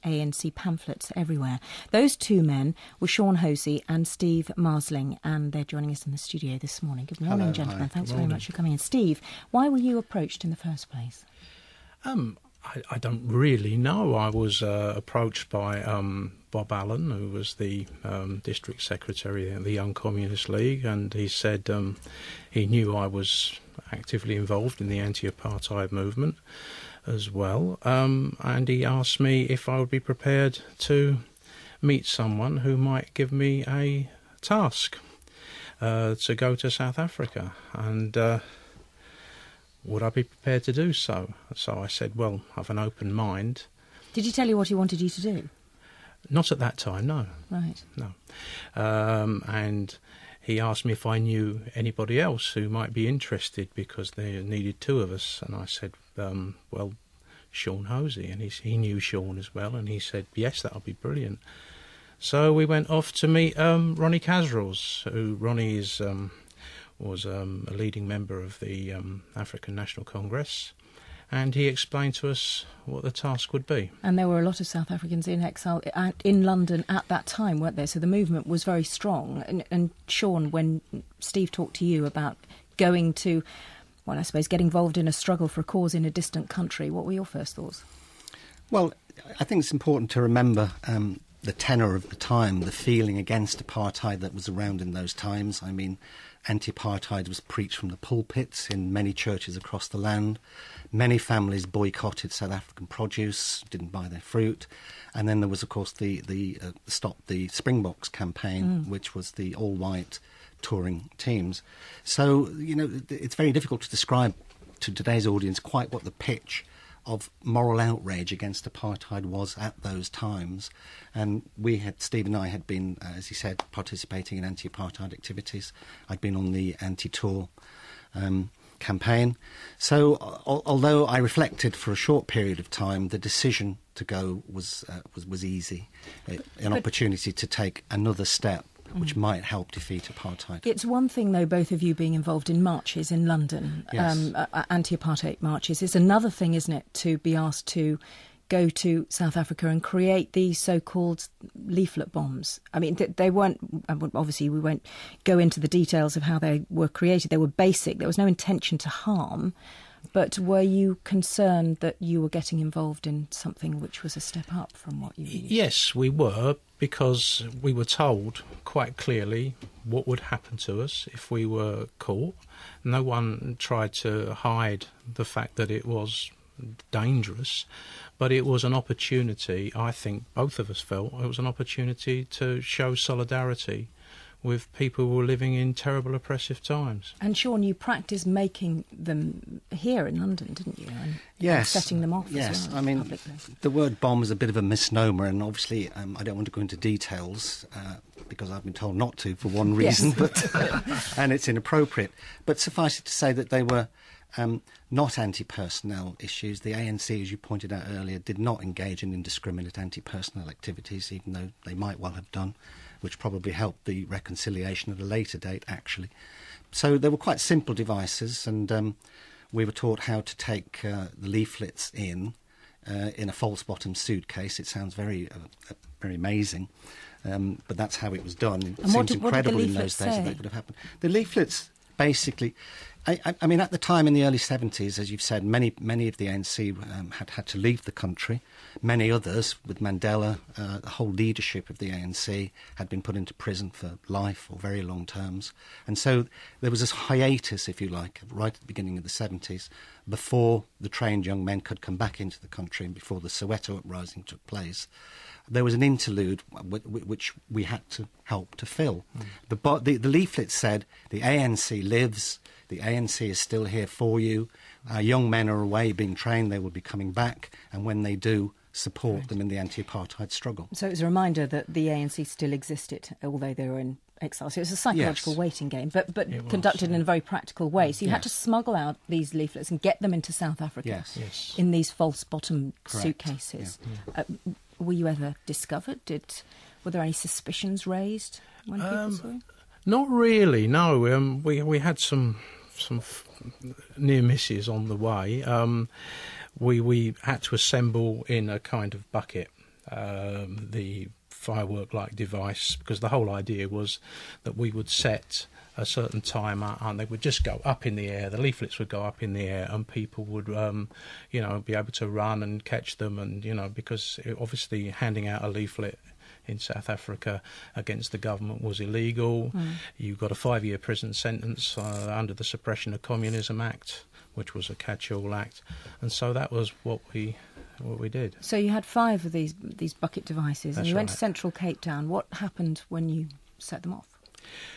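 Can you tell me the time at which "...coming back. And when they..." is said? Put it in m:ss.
4:26.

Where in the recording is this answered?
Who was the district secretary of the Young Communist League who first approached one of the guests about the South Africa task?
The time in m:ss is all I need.
0:16.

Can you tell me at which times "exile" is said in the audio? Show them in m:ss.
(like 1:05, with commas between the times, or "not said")
1:15, 4:34.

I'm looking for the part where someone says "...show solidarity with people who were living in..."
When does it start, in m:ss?
3:02.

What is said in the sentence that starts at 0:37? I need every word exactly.
And uh, would I be prepared to do so?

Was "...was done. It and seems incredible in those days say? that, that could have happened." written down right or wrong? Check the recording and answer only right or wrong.
right.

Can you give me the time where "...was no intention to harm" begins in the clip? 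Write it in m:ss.
2:38.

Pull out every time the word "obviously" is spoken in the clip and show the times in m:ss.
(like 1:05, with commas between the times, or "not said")
2:34, 3:15, 5:14.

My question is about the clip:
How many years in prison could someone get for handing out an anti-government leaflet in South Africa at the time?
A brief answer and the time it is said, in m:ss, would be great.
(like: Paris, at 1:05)
5, at 5:20.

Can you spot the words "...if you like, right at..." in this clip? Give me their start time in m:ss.
4:07.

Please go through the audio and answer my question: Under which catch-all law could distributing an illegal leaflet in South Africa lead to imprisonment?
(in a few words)
Suppression of Communism Act.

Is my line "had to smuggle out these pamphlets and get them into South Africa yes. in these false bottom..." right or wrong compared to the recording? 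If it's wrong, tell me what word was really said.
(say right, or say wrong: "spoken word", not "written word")
wrong: "leaflets", not "pamphlets".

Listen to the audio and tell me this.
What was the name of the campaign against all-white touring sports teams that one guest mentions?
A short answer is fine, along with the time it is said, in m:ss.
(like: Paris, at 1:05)
Stop the Springboks, at 1:46.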